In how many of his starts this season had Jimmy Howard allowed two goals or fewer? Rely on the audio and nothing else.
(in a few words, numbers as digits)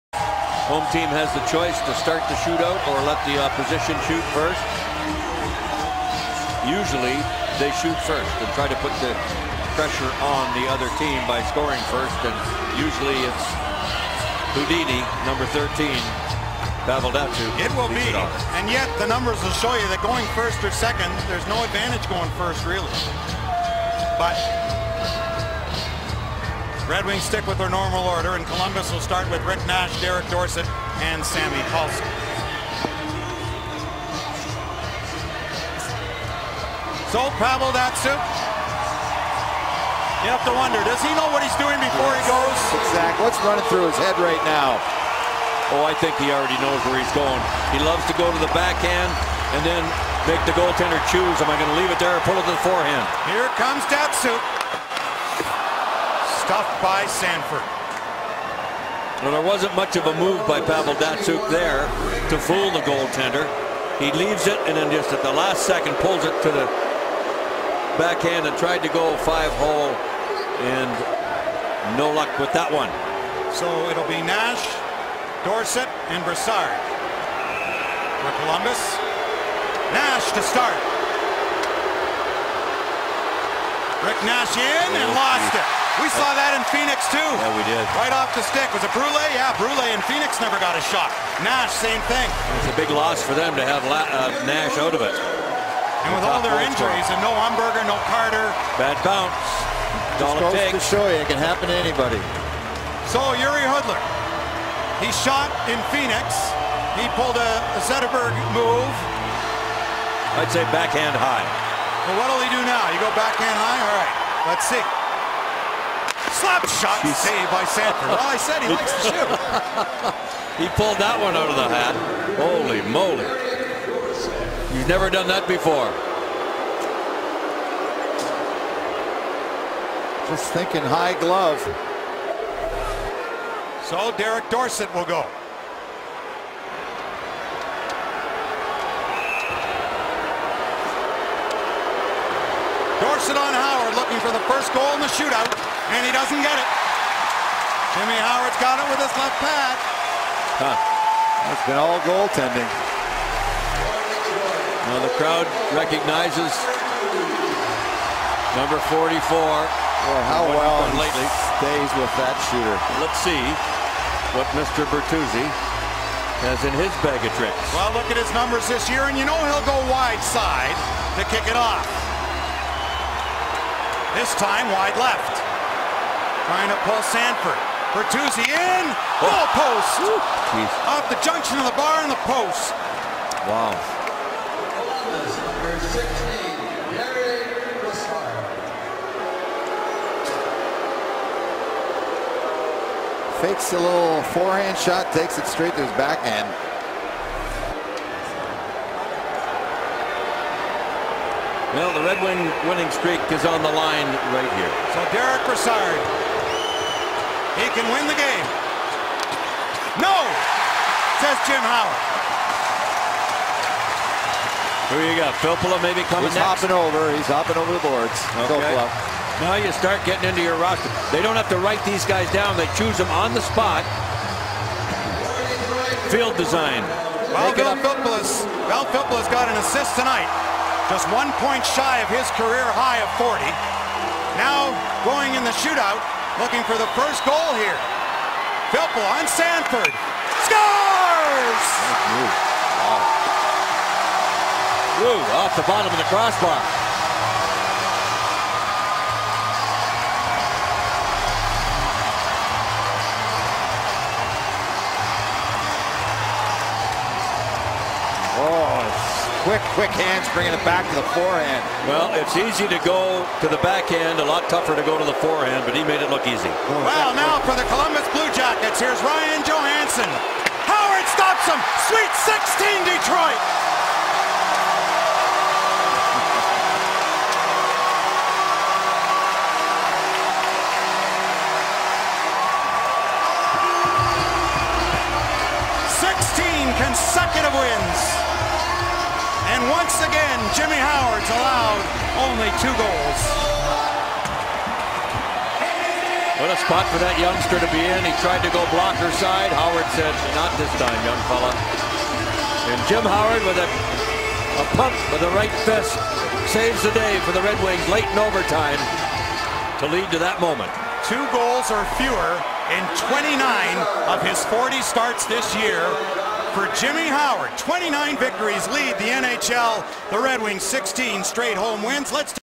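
29.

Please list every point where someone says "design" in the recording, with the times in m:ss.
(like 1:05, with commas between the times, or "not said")
3:46.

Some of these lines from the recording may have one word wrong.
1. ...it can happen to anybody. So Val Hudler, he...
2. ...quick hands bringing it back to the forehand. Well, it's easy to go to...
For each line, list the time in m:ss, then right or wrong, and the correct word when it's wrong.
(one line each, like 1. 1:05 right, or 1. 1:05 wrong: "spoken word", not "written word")
1. 1:41 wrong: "Jiri", not "Val"
2. 4:19 right.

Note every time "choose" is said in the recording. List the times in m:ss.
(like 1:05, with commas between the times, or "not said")
0:51, 3:42.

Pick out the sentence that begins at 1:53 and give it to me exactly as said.
All right, let's see slap shot Jeez.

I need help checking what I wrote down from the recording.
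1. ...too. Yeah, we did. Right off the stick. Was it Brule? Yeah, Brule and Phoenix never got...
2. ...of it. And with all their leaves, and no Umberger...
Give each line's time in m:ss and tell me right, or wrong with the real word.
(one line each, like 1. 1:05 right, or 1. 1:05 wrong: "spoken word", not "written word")
1. 1:27 right
2. 1:34 wrong: "injuries", not "leaves".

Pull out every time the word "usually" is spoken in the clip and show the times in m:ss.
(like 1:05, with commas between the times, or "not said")
0:06, 0:12.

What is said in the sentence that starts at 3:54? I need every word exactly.
Now going in the shootout, looking for the first goal here.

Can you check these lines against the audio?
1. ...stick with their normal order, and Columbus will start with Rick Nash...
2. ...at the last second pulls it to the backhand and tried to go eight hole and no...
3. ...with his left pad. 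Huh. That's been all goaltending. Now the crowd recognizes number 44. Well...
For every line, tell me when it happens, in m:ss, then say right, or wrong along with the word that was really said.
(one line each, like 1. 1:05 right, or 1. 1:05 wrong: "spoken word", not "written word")
1. 0:27 right
2. 1:05 wrong: "five", not "eight"
3. 2:28 right.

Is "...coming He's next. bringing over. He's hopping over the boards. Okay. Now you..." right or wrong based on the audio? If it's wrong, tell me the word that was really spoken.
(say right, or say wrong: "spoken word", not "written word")
wrong: "hopping", not "bringing".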